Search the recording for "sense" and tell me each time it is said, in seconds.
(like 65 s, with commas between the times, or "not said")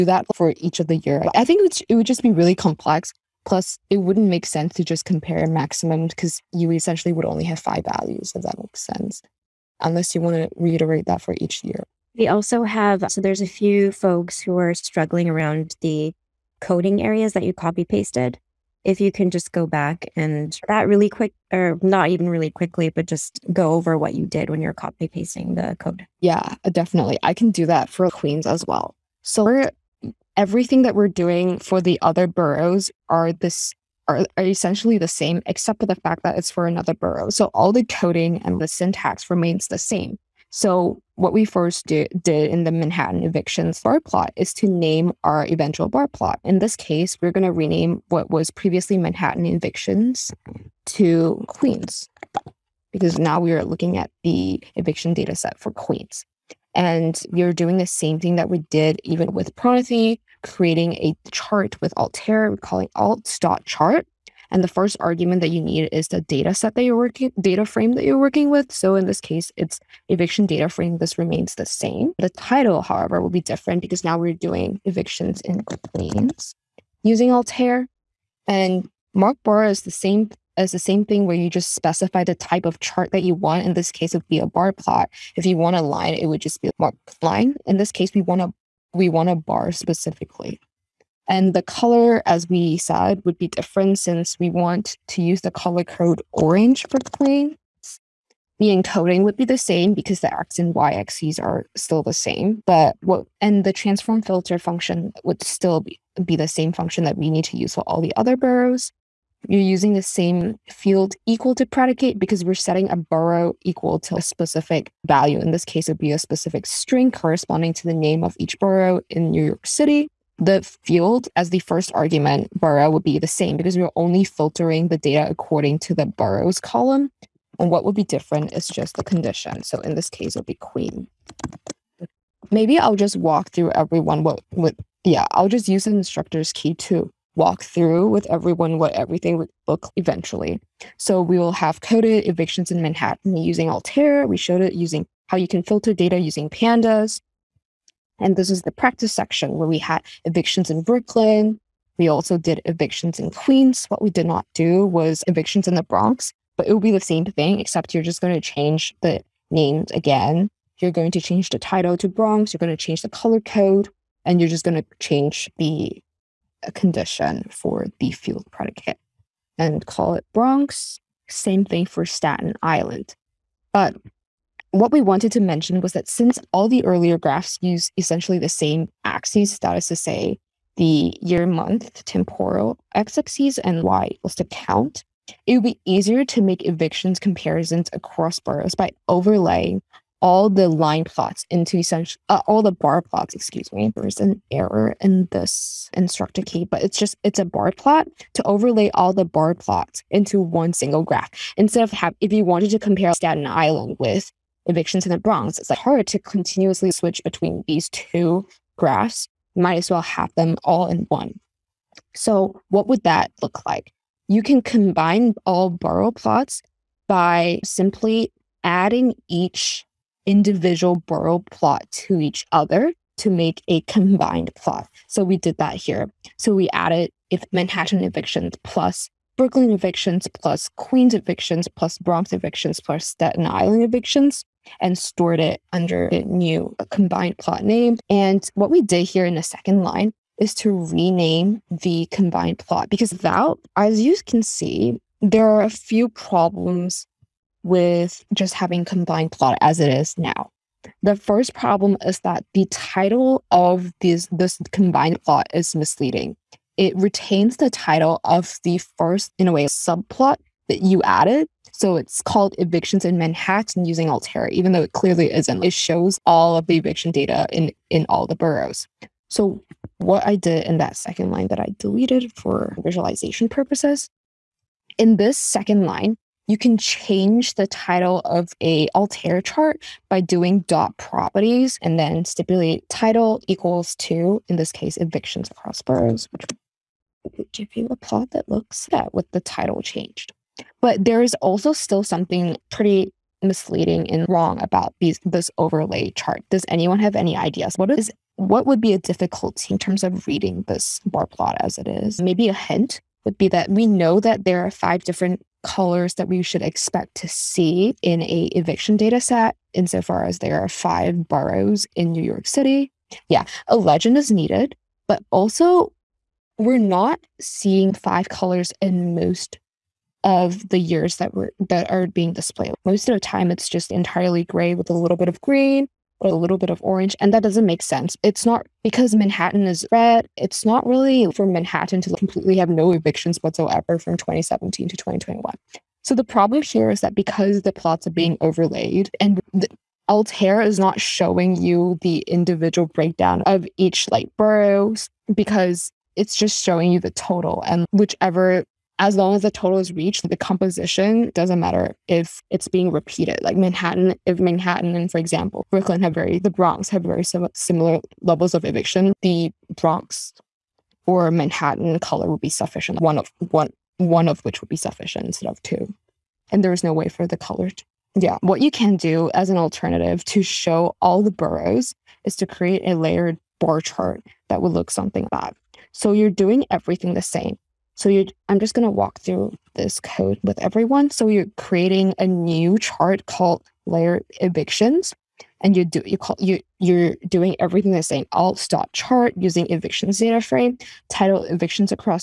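4 s, 8 s, 327 s.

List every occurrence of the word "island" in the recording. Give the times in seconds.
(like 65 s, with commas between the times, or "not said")
172 s, 203 s, 233 s.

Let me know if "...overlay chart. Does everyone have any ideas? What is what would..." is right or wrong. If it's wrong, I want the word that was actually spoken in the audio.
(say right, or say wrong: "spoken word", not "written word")
wrong: "anyone", not "everyone".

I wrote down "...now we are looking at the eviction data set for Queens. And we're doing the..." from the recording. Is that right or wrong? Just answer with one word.
right.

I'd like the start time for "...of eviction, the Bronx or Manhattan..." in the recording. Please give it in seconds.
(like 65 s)
358 s.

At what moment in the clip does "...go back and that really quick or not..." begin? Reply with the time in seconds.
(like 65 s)
19 s.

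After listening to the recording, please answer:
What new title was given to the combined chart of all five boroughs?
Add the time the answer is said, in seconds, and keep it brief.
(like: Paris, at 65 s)
Evictions across boroughs, at 284 s.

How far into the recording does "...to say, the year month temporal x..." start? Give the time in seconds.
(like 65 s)
179 s.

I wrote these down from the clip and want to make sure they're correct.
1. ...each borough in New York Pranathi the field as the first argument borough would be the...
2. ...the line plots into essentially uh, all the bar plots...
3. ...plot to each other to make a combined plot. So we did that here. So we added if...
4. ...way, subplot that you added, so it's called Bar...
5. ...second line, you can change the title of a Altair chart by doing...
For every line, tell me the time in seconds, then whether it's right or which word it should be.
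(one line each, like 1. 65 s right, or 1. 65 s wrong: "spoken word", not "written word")
1. 118 s wrong: "City", not "Pranathi"
2. 190 s right
3. 221 s right
4. 259 s wrong: "Evictions", not "Bar"
5. 275 s right.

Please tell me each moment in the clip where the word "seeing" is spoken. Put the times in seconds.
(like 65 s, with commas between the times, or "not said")
317 s.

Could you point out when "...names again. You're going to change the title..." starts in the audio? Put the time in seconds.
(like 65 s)
159 s.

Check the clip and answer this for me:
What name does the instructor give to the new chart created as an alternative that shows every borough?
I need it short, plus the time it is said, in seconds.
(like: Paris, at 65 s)
layer evictions, at 383 s.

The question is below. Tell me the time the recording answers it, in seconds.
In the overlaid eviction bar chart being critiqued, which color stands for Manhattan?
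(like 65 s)
329 s.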